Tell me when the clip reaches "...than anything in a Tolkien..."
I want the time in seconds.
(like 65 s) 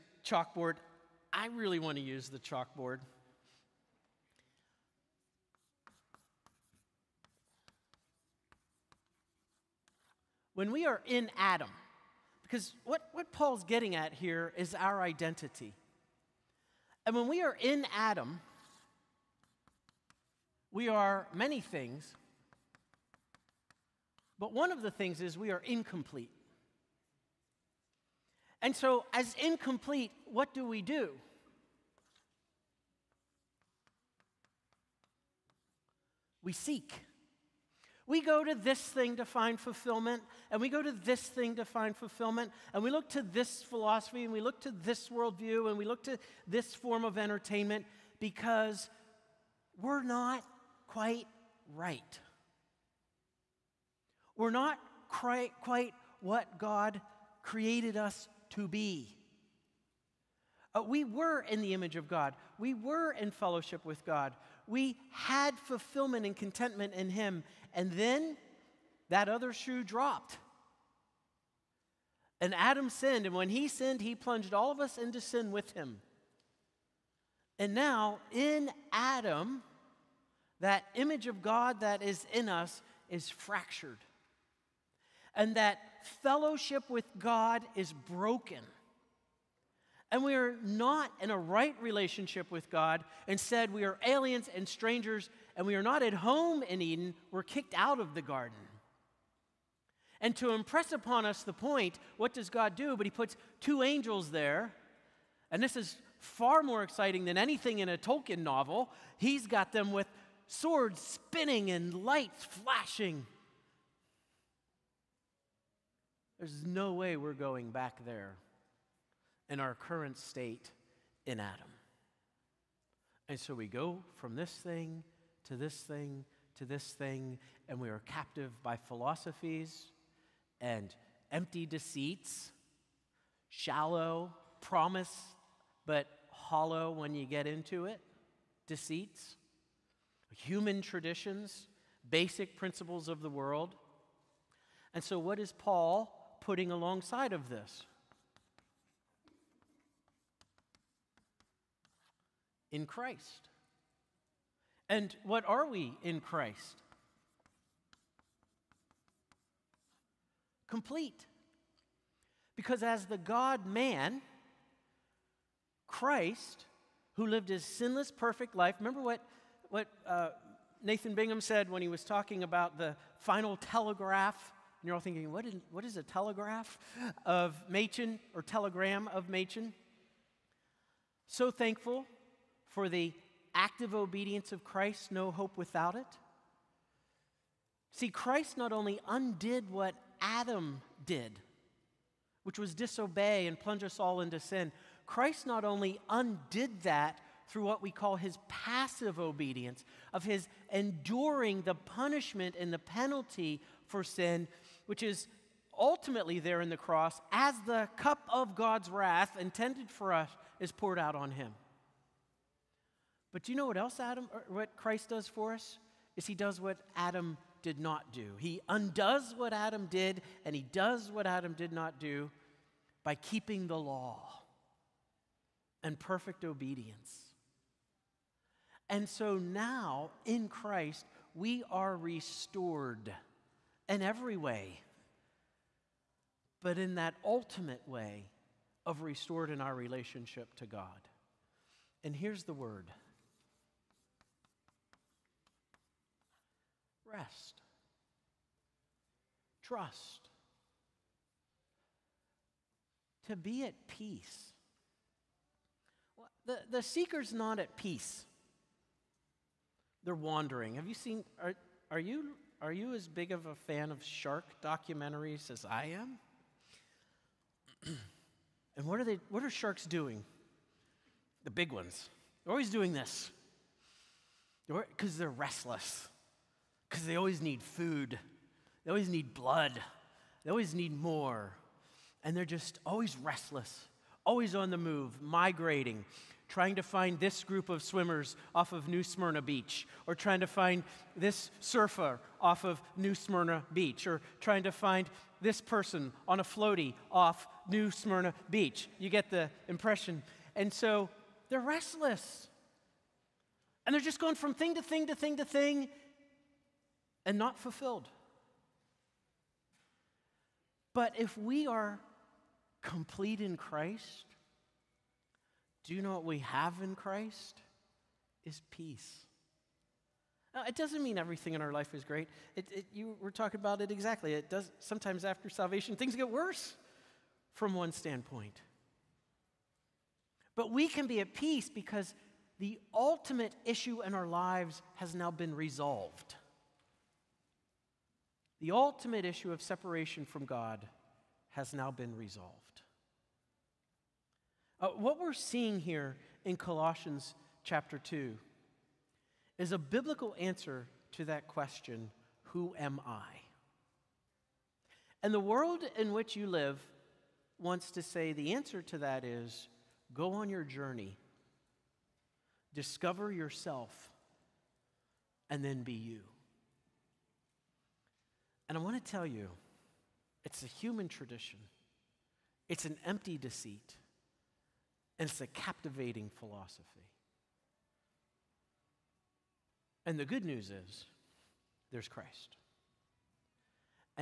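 107 s.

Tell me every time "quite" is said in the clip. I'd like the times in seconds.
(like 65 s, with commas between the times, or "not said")
50 s, 55 s.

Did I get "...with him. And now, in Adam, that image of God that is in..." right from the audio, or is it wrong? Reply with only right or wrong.
right.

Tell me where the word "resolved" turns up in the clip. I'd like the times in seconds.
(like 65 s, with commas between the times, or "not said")
335 s, 342 s.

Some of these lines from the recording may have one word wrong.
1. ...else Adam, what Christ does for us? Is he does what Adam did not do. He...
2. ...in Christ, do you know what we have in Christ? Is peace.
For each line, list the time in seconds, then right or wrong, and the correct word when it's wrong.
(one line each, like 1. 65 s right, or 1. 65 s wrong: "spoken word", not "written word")
1. 213 s right
2. 313 s right.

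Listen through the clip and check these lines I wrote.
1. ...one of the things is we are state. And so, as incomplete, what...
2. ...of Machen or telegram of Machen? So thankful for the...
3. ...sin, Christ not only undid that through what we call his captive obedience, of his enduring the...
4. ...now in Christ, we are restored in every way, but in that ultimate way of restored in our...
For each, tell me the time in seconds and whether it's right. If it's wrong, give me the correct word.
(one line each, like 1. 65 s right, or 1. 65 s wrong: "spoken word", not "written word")
1. 24 s wrong: "incomplete", not "state"
2. 177 s right
3. 194 s wrong: "passive", not "captive"
4. 229 s right.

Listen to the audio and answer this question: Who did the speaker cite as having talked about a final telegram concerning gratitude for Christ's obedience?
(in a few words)
Nathan Bingham.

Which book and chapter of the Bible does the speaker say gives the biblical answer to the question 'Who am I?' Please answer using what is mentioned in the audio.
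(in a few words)
Colossians 2.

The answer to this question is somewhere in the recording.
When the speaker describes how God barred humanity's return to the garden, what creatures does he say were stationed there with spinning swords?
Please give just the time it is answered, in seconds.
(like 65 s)
103 s.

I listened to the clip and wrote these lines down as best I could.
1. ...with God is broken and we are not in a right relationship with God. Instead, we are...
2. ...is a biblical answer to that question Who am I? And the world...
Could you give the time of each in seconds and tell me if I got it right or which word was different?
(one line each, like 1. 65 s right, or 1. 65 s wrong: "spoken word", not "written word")
1. 86 s right
2. 349 s right.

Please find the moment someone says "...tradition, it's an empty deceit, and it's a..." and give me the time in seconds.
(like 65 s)
371 s.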